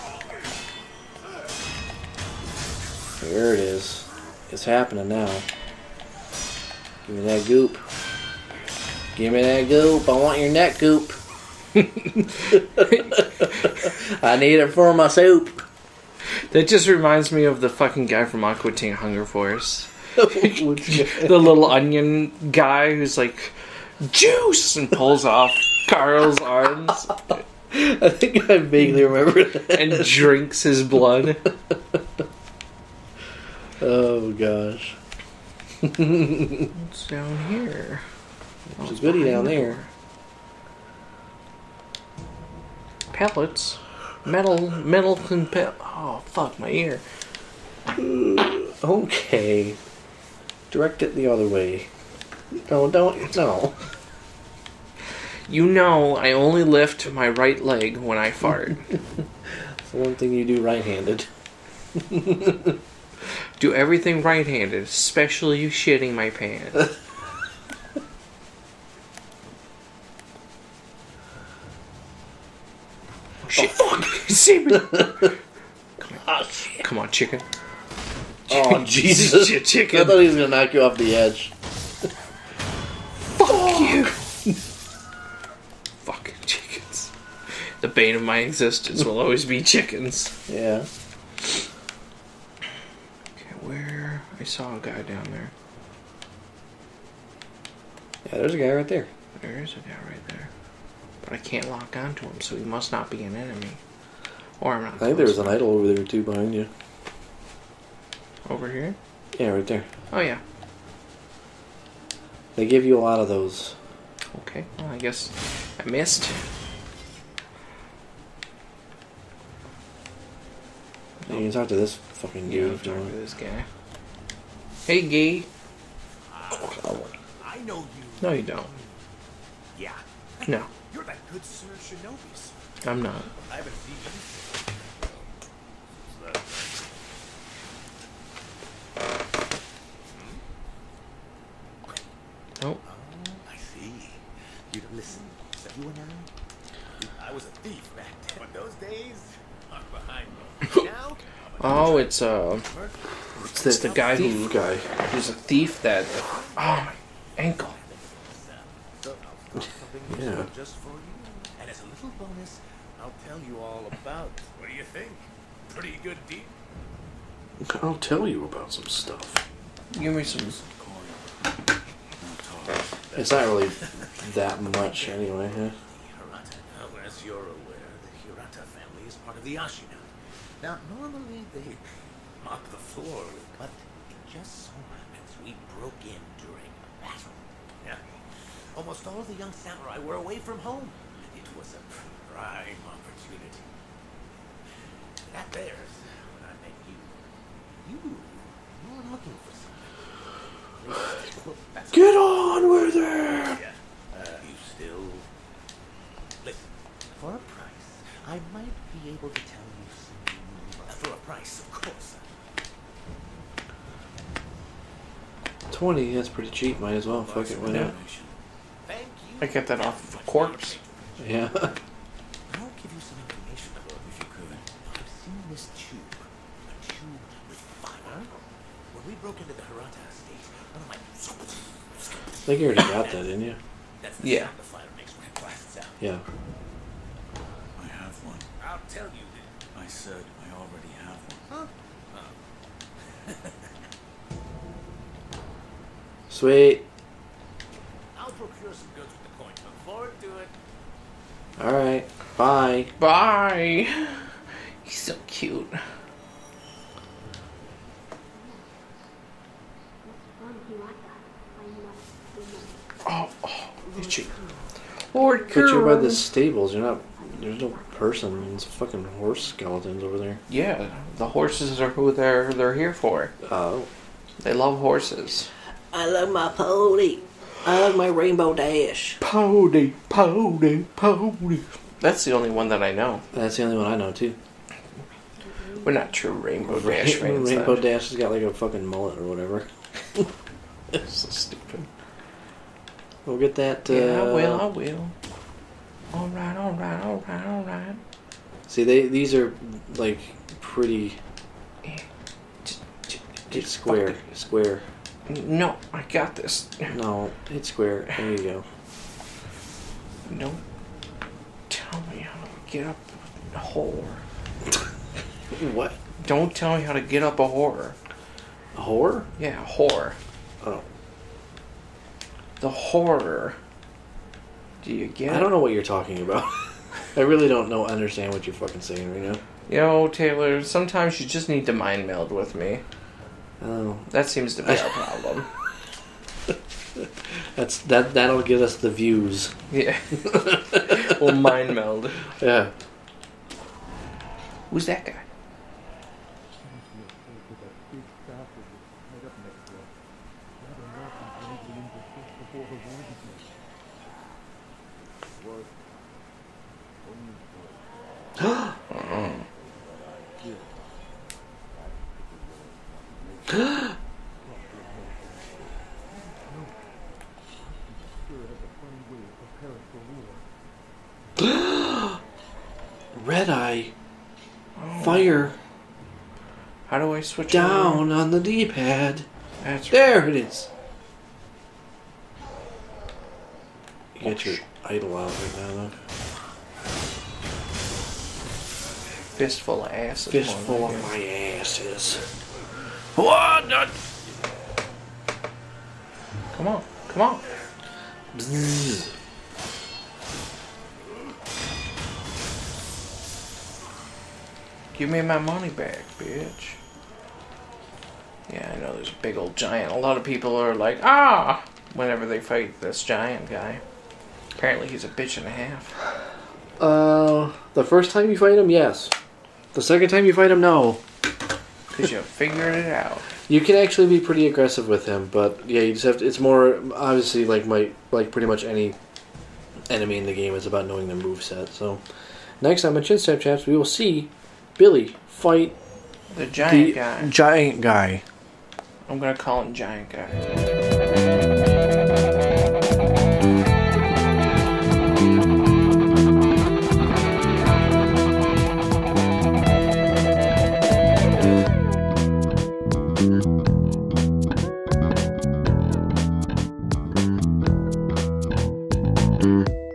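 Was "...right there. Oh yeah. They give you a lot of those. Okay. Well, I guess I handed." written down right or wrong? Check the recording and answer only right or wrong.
wrong.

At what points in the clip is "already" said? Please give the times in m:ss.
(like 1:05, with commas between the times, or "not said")
3:52, 4:00.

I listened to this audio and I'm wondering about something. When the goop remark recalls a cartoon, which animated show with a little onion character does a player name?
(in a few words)
Aqua Teen Hunger Force.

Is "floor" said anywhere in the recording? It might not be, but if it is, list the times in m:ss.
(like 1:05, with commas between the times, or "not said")
3:02.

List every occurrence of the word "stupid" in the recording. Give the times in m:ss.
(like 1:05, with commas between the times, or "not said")
4:51.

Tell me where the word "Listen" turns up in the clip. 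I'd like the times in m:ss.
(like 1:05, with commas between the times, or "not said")
3:26.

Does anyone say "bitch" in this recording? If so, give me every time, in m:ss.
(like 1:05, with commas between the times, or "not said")
6:46, 6:55.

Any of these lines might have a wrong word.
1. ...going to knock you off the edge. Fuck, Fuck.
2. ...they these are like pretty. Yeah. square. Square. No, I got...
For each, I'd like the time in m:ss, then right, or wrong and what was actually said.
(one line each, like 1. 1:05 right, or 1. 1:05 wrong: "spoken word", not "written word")
1. 1:20 right
2. 4:58 right.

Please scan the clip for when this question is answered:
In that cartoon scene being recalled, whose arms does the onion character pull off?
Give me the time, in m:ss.
0:25.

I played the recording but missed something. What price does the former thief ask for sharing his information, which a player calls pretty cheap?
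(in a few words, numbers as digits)
20.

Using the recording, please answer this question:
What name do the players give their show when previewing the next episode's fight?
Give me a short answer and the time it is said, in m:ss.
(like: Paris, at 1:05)
Chinstrap Chaps, at 7:13.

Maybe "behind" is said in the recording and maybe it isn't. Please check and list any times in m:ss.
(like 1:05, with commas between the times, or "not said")
1:46, 2:29.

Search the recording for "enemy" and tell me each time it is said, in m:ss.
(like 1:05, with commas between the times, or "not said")
1:43, 7:09.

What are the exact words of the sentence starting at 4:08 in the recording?
I'll procure some goods with the coin.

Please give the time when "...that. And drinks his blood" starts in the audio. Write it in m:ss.
0:29.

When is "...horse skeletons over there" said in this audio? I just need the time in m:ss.
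4:29.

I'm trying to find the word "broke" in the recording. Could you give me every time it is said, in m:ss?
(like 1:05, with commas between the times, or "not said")
3:05, 3:49.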